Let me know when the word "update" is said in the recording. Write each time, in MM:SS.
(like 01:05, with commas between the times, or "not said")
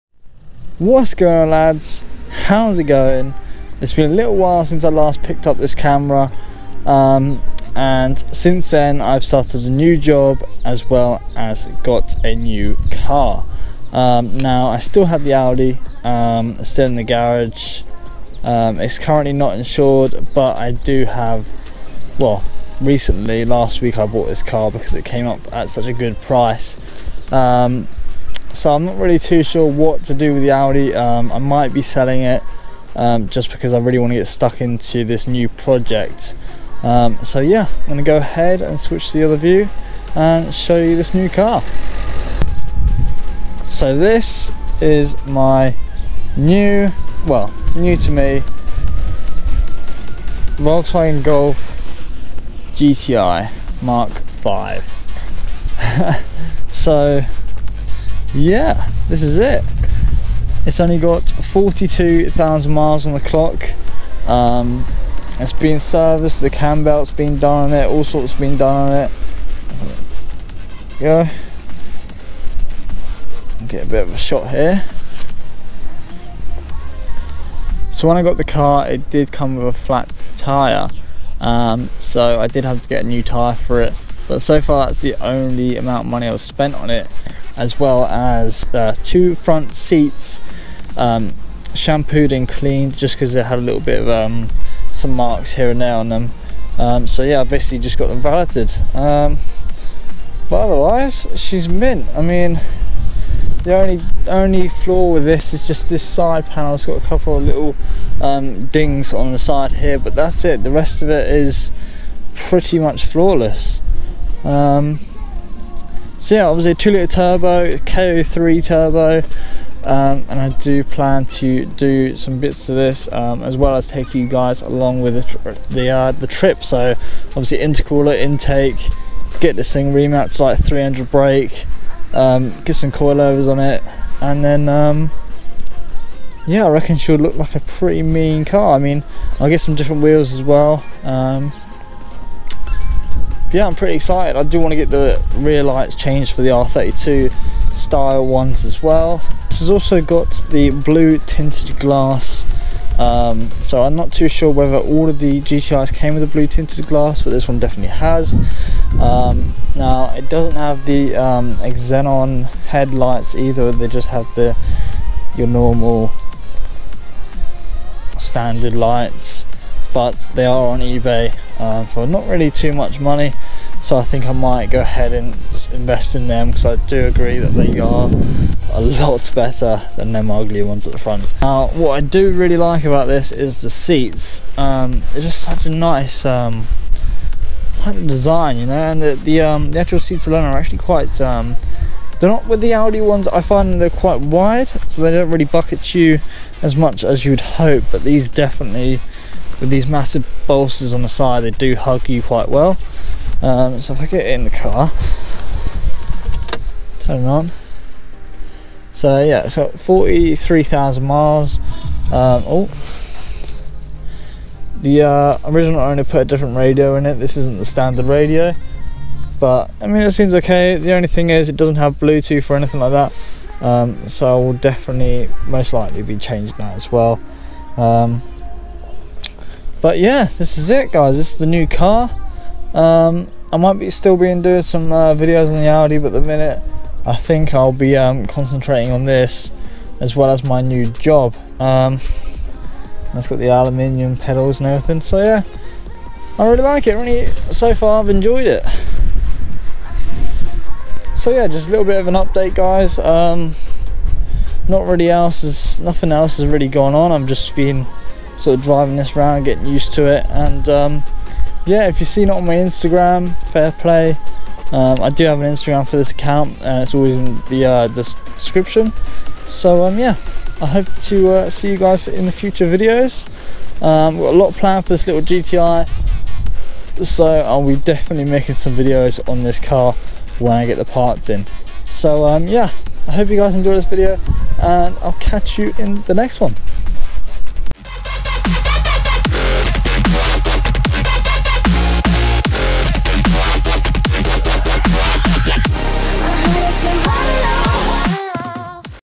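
04:12.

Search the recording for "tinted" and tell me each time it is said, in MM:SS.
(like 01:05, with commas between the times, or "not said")
02:31, 02:36.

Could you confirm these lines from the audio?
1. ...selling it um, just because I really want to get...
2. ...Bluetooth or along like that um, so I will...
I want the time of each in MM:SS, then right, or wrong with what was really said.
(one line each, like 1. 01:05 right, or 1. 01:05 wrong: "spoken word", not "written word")
1. 00:31 right
2. 03:41 wrong: "anything", not "along".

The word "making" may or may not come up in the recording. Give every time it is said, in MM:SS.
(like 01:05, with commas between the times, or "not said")
04:38.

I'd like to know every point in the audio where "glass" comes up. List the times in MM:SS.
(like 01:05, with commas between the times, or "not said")
02:31, 02:36.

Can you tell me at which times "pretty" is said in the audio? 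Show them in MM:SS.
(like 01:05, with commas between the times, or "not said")
01:52, 02:17, 02:23.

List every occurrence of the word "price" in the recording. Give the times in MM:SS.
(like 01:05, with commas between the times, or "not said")
00:26.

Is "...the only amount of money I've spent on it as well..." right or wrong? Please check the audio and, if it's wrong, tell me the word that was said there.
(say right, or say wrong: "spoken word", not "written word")
right.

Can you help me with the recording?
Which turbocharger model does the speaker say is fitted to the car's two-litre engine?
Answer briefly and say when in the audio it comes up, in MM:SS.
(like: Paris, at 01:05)
K03, at 01:57.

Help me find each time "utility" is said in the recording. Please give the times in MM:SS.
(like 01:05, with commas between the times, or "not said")
not said.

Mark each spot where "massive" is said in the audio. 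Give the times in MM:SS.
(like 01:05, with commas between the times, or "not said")
03:19.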